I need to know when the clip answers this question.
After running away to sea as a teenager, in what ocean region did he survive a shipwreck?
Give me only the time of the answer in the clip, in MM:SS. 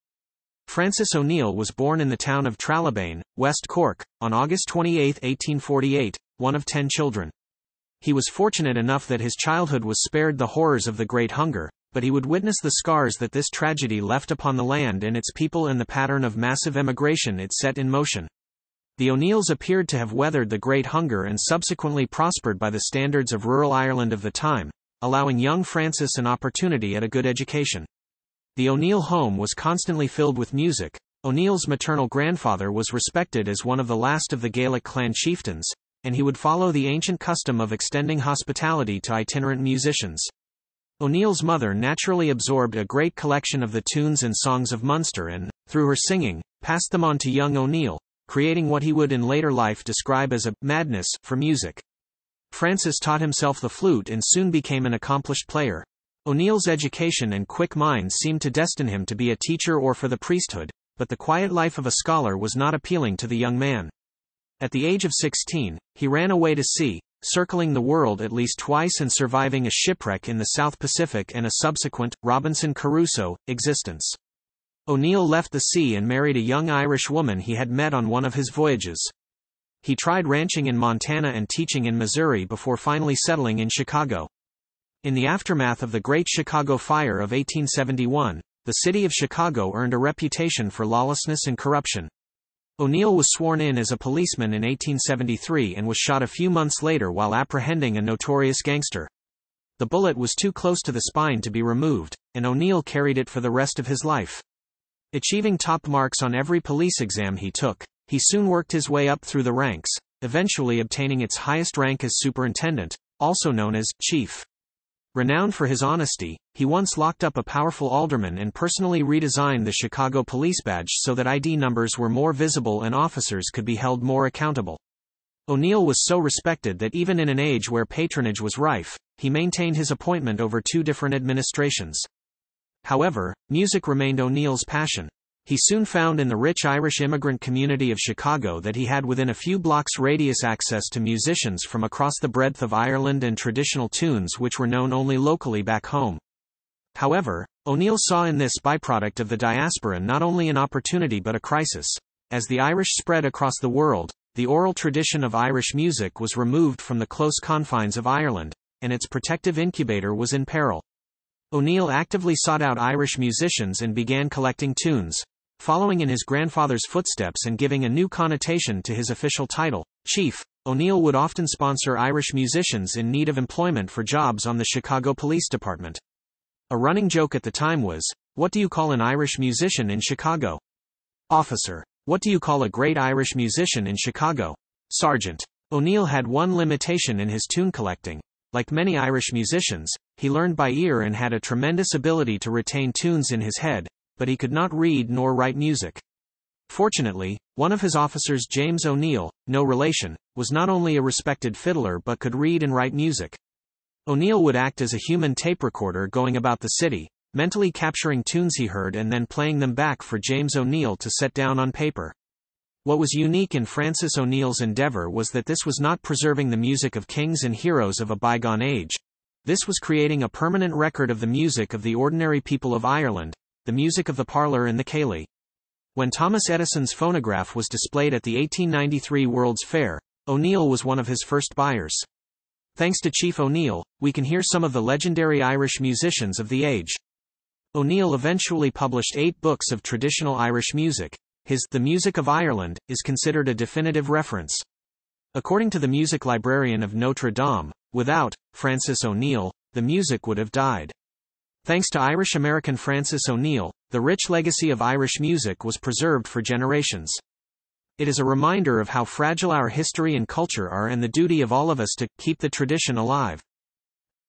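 01:10.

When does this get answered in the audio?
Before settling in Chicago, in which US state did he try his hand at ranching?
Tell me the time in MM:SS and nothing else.
01:20.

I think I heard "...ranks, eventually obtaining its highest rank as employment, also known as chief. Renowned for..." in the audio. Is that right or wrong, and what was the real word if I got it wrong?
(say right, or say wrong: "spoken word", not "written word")
wrong: "superintendent", not "employment".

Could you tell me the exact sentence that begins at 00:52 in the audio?
Francis taught himself the flute and soon became an accomplished player.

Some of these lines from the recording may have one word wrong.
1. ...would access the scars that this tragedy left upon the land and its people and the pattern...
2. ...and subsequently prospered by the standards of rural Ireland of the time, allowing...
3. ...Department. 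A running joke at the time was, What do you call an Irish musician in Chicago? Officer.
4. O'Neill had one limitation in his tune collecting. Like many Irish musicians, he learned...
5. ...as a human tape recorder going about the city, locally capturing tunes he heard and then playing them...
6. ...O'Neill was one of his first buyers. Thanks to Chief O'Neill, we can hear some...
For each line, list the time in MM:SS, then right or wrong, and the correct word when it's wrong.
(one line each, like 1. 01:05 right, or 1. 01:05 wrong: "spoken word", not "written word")
1. 00:12 wrong: "witness", not "access"
2. 00:21 right
3. 02:55 right
4. 03:05 right
5. 03:24 wrong: "mentally", not "locally"
6. 03:50 right.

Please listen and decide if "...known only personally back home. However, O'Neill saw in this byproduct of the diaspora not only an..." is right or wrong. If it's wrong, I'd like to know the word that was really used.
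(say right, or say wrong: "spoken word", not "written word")
wrong: "locally", not "personally".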